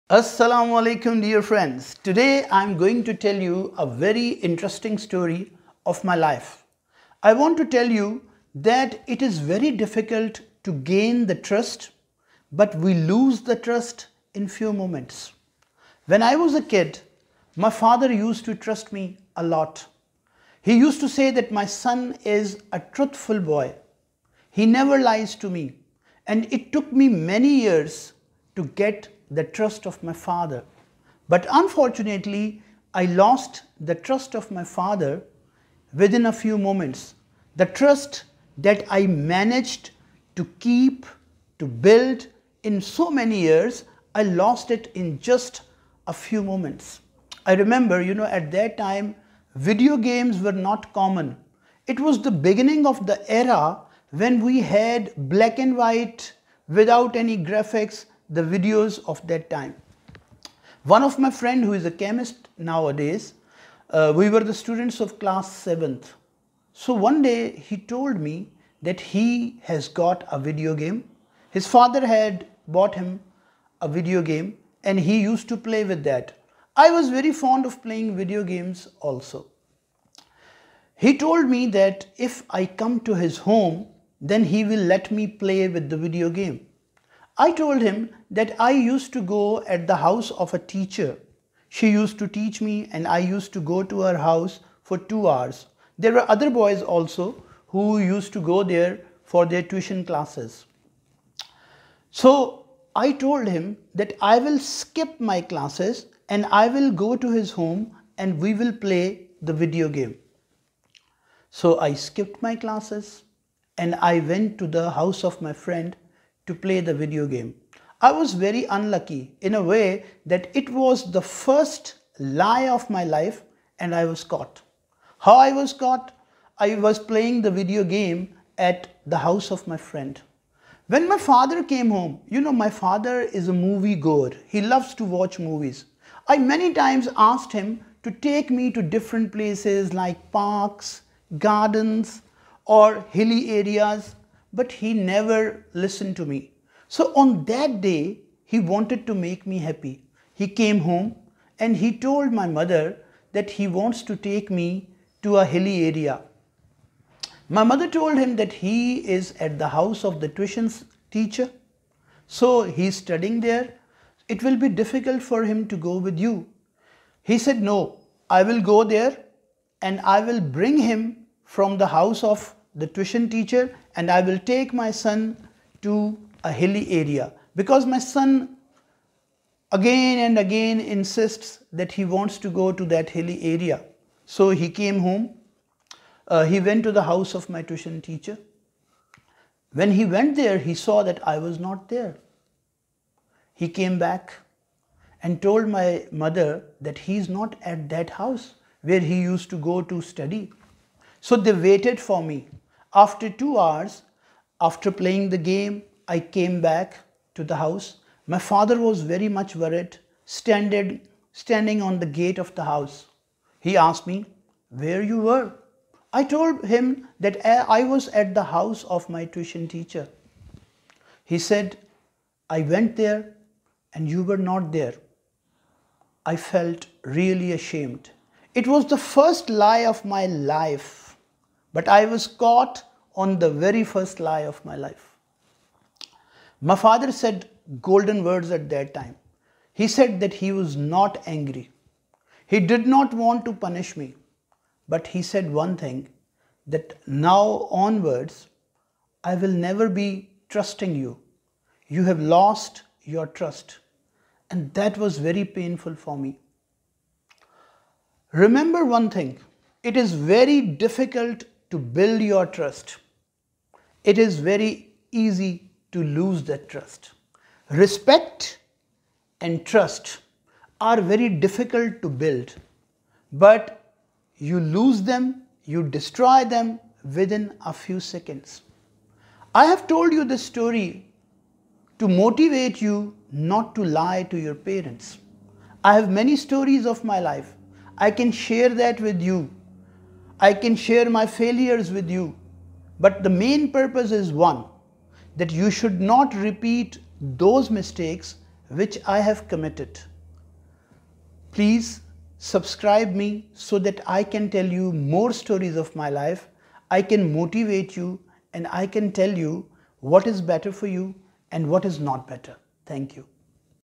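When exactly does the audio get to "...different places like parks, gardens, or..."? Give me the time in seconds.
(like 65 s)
138 s.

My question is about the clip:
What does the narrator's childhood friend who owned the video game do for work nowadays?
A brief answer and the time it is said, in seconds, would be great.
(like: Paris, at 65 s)
Chemist, at 61 s.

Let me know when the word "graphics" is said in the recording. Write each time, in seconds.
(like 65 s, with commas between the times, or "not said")
57 s.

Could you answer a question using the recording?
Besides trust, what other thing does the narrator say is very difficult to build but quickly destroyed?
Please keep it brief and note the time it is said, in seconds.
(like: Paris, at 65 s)
Respect, at 267 s.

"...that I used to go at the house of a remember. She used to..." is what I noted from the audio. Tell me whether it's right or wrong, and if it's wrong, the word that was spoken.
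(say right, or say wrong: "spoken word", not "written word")
wrong: "teacher", not "remember".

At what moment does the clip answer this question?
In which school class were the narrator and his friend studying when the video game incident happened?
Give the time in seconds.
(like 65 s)
65 s.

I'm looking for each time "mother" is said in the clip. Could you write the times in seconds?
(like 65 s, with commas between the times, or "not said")
152 s, 157 s, 196 s.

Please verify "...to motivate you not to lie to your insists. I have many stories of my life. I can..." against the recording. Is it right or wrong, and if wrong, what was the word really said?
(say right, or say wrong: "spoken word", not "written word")
wrong: "parents", not "insists".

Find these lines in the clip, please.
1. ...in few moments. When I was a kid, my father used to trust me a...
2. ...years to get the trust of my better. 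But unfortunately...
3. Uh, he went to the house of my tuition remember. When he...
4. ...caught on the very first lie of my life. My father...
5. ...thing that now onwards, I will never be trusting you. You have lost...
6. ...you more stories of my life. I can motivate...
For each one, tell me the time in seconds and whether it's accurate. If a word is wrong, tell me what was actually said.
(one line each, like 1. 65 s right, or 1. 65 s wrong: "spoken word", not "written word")
1. 14 s right
2. 27 s wrong: "father", not "better"
3. 186 s wrong: "teacher", not "remember"
4. 232 s right
5. 245 s right
6. 304 s right.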